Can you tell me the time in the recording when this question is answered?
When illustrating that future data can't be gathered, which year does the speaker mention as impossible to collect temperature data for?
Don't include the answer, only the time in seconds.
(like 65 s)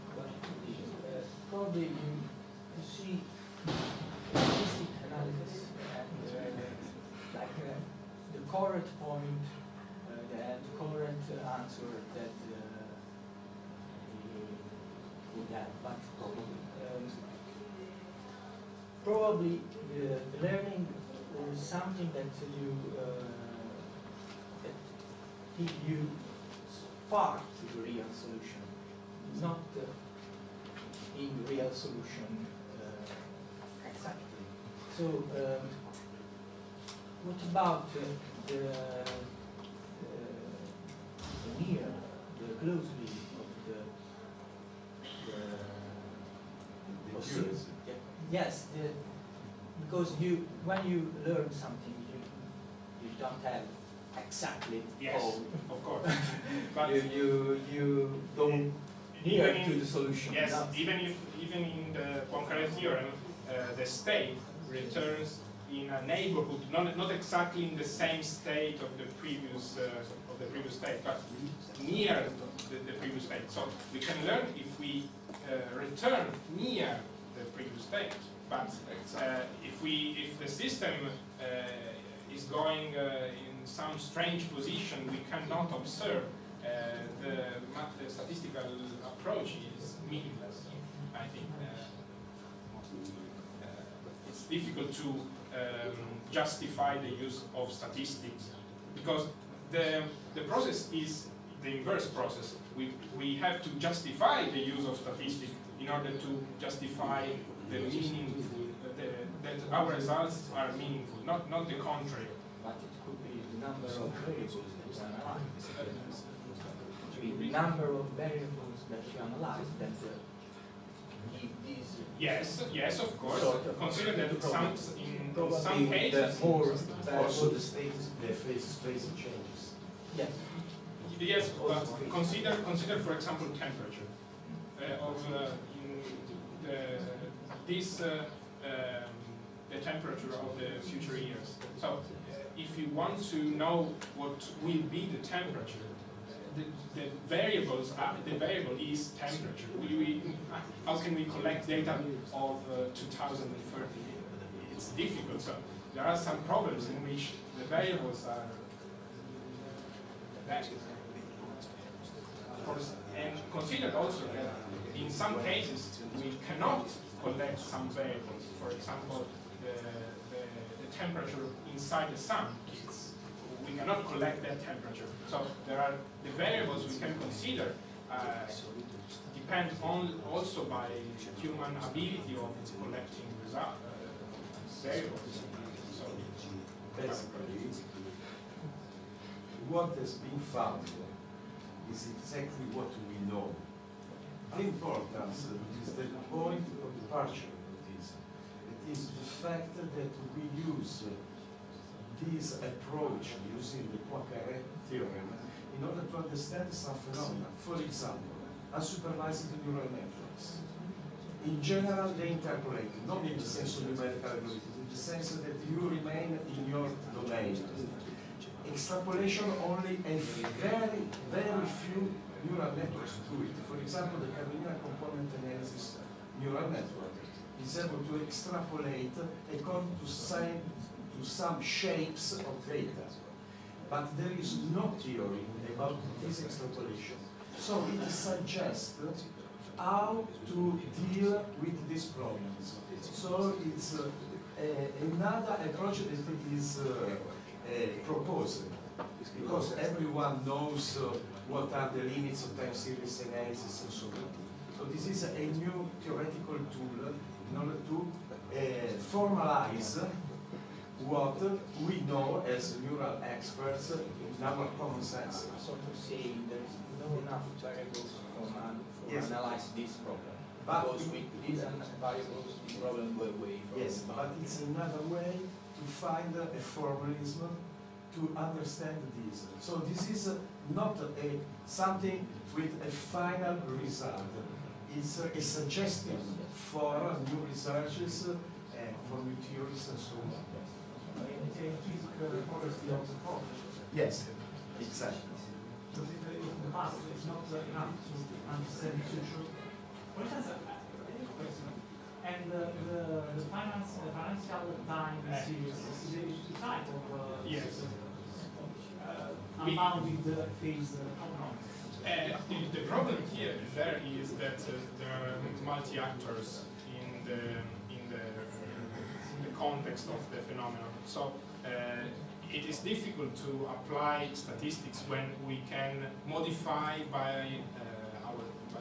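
152 s.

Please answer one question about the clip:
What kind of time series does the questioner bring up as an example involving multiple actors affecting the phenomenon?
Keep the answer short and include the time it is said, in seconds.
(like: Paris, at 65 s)
financial, at 304 s.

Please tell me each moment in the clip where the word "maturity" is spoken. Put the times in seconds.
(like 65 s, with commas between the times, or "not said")
not said.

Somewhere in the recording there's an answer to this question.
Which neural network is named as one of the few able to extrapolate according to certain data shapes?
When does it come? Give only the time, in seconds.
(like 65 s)
224 s.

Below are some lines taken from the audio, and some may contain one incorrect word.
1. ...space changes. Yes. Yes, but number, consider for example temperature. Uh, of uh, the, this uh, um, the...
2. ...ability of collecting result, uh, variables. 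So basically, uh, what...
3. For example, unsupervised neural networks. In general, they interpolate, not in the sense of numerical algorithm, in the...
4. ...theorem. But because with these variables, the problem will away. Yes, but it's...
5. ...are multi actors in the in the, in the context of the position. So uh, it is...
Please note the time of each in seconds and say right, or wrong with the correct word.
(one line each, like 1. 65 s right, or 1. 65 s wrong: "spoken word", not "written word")
1. 128 s wrong: "consider", not "number"
2. 181 s right
3. 207 s right
4. 270 s wrong: "problem", not "theorem"
5. 315 s wrong: "phenomenon", not "position".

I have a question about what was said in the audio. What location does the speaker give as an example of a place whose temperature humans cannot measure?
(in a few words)
inside the sun.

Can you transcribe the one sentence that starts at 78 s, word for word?
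But uh, if we, if the system uh, is going uh, in some strange position, we cannot observe.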